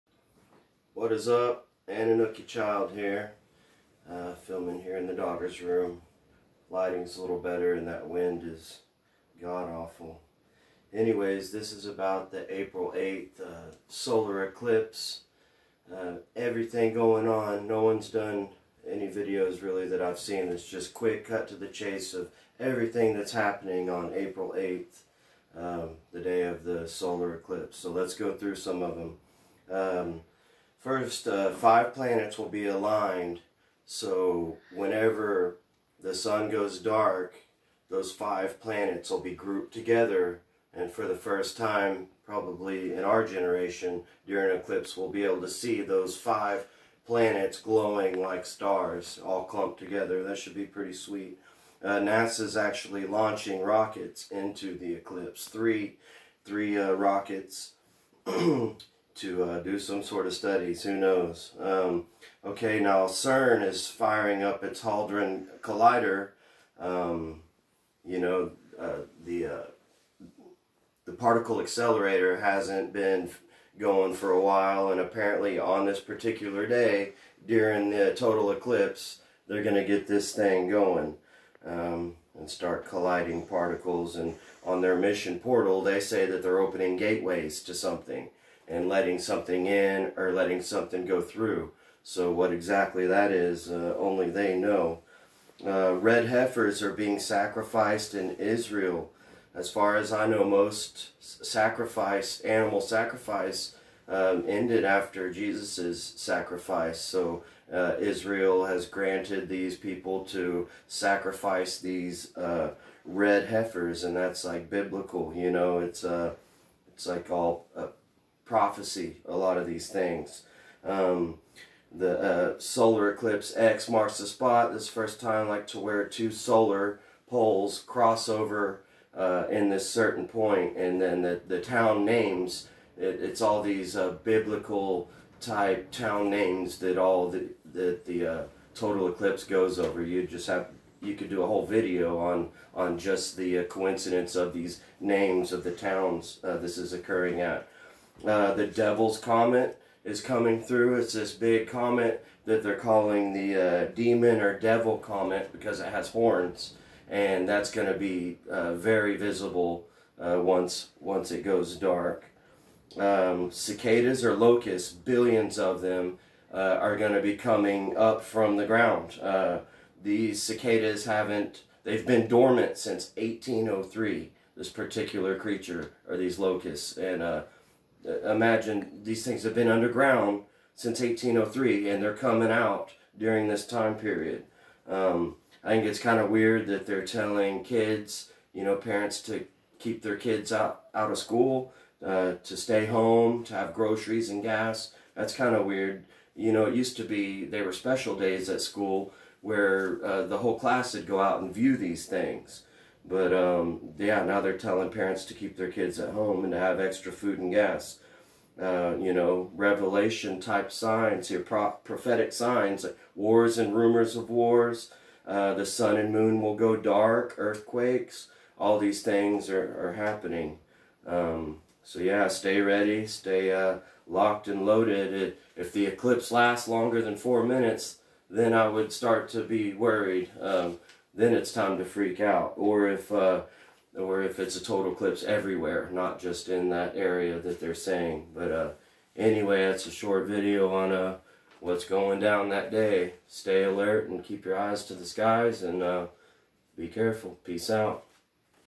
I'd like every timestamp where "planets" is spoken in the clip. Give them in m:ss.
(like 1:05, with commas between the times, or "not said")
0:31, 0:38, 0:47.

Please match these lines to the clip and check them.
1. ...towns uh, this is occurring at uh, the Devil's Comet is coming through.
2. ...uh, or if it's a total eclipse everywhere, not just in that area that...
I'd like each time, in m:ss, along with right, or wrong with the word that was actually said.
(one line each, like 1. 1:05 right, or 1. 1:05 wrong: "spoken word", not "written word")
1. 2:25 right
2. 3:53 right.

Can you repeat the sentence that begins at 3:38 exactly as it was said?
All these things are, are happening.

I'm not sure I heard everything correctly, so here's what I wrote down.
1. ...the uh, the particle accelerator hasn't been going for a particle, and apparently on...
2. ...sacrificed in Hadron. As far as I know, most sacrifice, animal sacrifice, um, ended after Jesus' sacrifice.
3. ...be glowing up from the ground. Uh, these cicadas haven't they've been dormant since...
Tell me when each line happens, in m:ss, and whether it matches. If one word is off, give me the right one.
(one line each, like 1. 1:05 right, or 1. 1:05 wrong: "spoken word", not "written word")
1. 1:09 wrong: "while", not "particle"
2. 1:37 wrong: "Israel", not "Hadron"
3. 2:47 wrong: "coming", not "glowing".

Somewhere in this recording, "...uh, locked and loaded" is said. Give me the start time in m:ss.
3:43.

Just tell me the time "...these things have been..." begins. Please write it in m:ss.
2:59.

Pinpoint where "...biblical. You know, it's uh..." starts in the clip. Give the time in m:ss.
1:54.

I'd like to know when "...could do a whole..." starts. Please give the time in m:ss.
2:21.